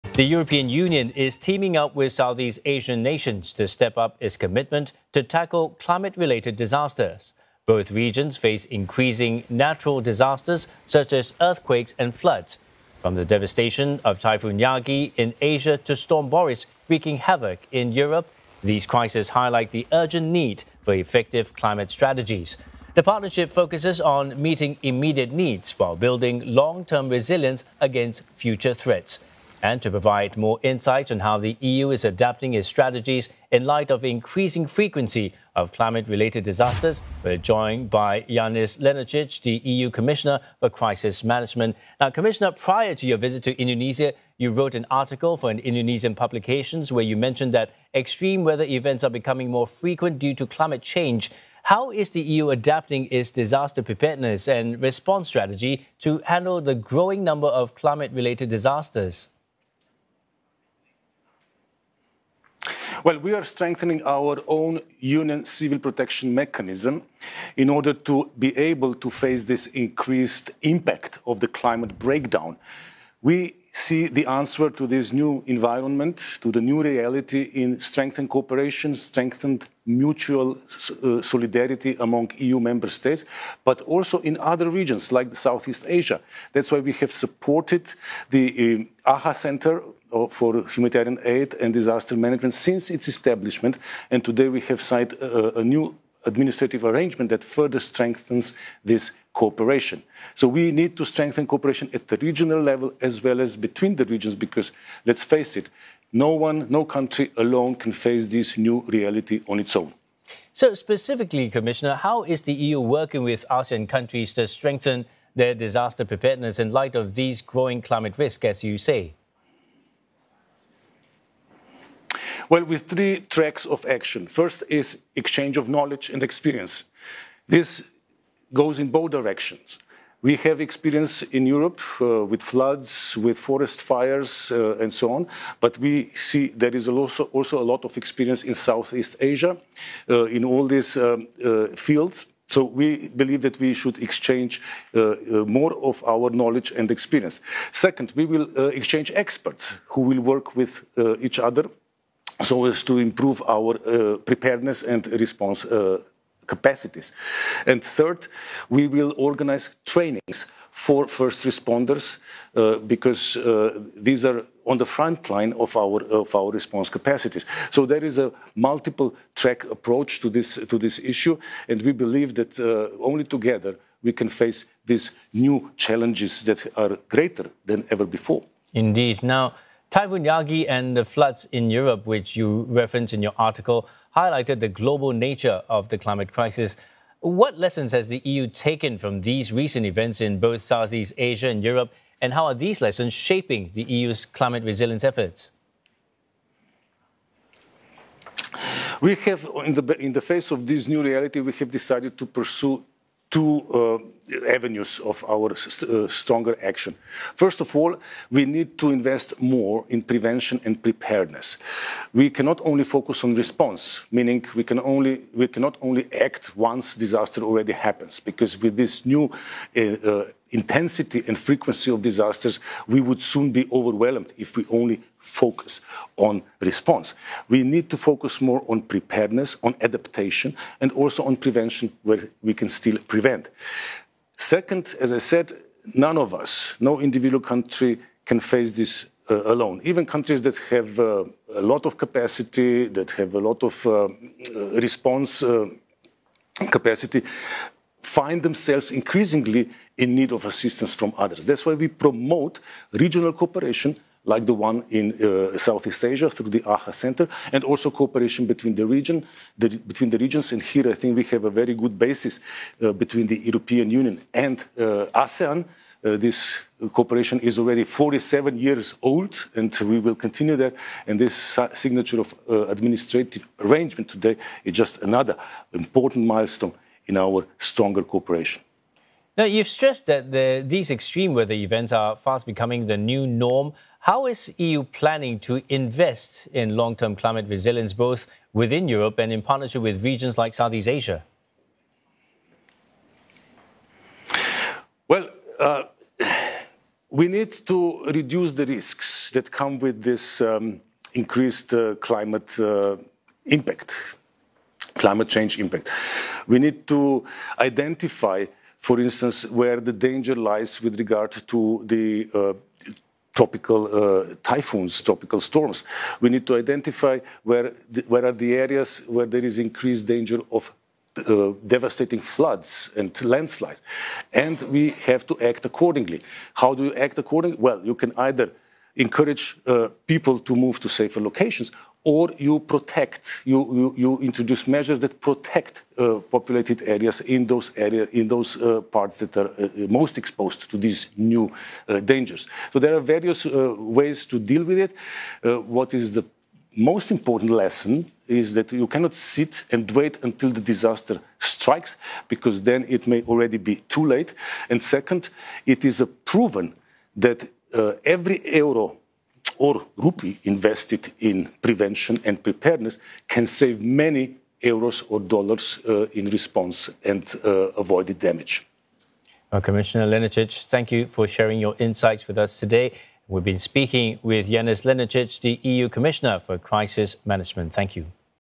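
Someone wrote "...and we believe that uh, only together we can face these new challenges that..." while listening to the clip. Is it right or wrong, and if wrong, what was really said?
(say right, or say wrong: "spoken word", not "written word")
right.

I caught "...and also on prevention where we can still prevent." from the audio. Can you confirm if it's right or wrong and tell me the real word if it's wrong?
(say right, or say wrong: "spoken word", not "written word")
right.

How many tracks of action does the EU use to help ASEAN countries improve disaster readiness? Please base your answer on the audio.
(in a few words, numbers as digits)
3.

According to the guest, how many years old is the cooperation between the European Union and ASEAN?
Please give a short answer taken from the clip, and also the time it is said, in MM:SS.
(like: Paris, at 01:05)
47, at 04:27.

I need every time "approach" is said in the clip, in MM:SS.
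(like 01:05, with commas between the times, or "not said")
02:49.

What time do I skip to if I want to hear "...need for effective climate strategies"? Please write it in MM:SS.
00:20.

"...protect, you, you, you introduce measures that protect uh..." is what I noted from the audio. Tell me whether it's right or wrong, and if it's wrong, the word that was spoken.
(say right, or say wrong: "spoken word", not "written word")
right.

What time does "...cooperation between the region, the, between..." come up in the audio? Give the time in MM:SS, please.
04:18.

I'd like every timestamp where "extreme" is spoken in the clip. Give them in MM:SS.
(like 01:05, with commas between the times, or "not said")
00:47, 04:40.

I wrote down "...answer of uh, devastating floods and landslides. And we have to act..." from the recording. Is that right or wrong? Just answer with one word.
wrong.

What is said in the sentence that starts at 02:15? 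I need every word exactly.
But we see there is also, also a lot of experience in Southeast Asia uh, in all these um, uh, fields.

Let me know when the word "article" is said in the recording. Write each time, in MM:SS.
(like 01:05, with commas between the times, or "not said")
00:44, 03:03.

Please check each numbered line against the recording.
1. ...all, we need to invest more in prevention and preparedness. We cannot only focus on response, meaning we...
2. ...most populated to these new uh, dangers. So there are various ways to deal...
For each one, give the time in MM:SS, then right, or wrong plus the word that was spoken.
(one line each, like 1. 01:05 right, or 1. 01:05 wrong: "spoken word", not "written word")
1. 03:27 right
2. 05:39 wrong: "exposed", not "populated".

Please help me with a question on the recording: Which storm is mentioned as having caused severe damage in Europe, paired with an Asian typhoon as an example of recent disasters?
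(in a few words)
Storm Boris.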